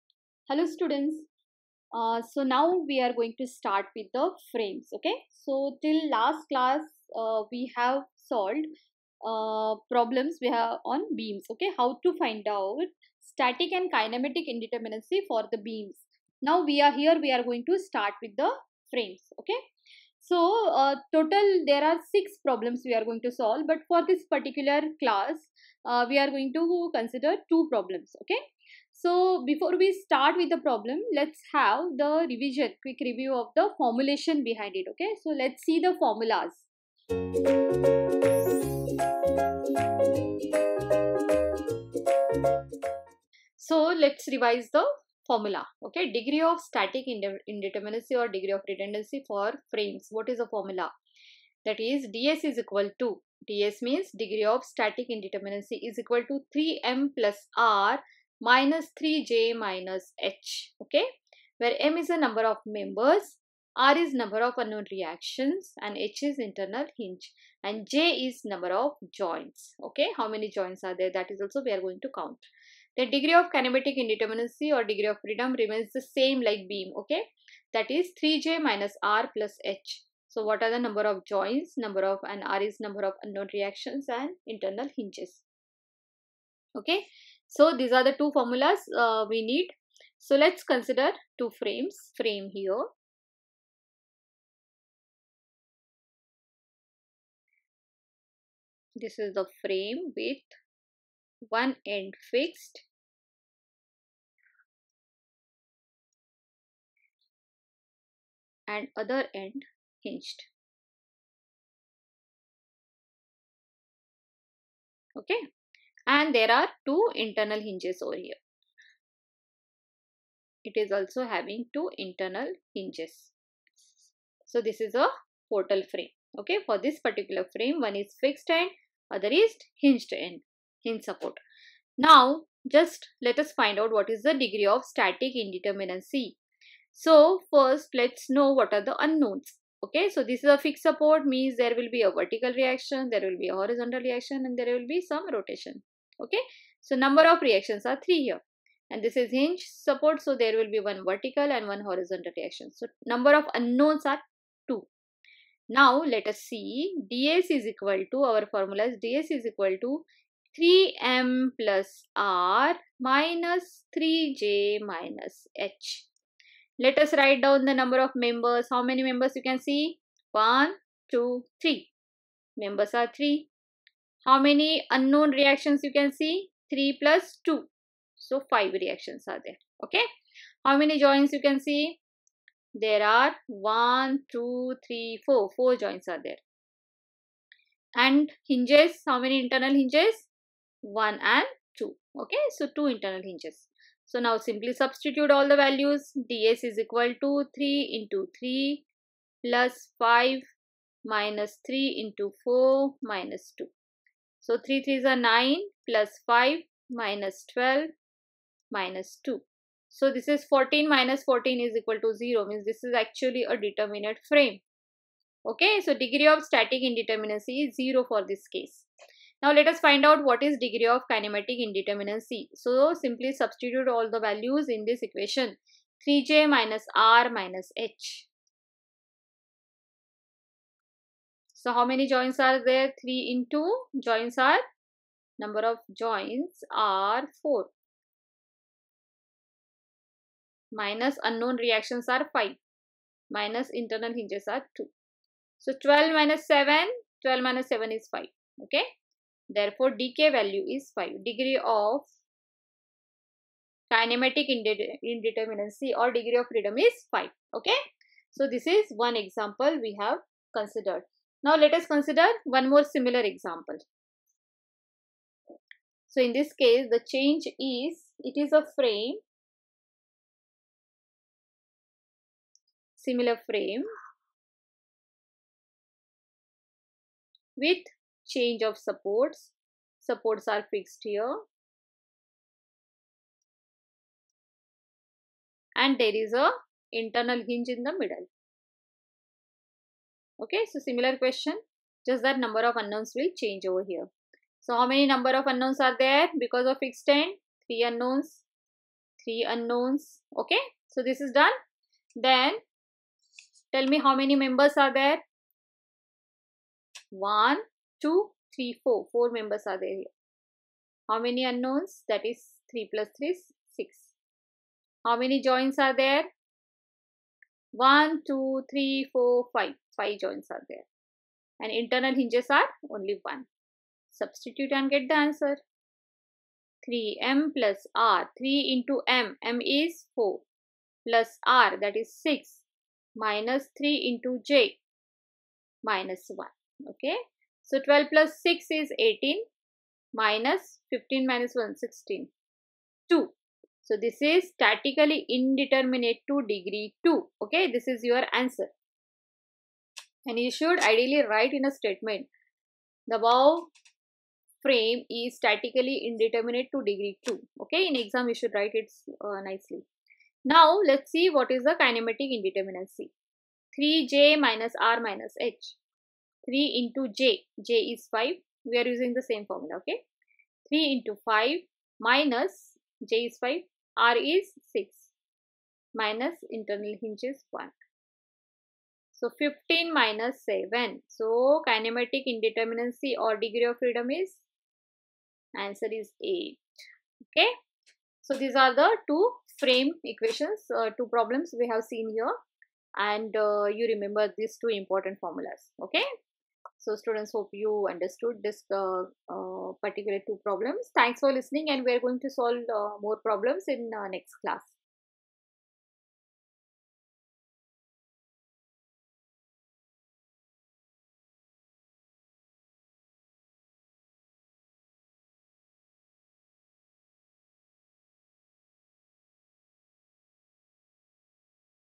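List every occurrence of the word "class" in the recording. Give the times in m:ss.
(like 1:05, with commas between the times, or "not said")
0:06, 0:25, 6:44.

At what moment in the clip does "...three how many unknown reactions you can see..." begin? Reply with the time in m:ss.
2:53.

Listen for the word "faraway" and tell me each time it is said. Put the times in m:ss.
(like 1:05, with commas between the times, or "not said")
not said.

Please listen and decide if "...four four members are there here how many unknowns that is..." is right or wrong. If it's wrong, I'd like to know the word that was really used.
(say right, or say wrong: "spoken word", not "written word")
right.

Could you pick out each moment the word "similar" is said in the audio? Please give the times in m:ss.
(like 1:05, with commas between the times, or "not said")
4:22, 4:32, 4:50.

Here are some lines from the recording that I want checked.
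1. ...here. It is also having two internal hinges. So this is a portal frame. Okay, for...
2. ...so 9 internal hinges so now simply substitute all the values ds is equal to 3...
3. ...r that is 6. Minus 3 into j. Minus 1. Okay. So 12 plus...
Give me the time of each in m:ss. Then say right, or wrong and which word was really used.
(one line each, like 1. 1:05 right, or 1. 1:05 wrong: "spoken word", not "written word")
1. 1:58 right
2. 3:12 wrong: "2", not "9"
3. 5:31 right.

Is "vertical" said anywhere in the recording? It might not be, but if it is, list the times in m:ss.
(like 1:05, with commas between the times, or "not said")
2:22, 2:31.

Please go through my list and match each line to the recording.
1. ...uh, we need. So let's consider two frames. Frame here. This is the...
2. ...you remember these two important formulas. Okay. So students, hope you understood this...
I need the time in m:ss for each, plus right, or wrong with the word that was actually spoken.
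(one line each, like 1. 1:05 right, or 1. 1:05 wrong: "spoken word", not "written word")
1. 1:28 right
2. 6:33 right.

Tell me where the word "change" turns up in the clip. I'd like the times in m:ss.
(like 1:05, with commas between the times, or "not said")
4:27, 4:38, 4:53.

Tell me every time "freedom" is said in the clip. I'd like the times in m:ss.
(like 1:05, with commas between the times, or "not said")
1:15, 4:16, 6:23.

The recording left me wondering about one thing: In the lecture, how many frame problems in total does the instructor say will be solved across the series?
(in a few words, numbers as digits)
6.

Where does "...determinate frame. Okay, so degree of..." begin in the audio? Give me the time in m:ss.
3:33.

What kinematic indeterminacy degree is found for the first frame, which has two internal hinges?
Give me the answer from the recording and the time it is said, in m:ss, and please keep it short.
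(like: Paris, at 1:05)
5, at 4:09.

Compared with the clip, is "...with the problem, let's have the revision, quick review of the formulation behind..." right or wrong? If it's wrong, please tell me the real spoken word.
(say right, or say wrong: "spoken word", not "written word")
right.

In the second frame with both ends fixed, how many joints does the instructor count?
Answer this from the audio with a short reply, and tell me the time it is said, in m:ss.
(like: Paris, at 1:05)
5, at 5:19.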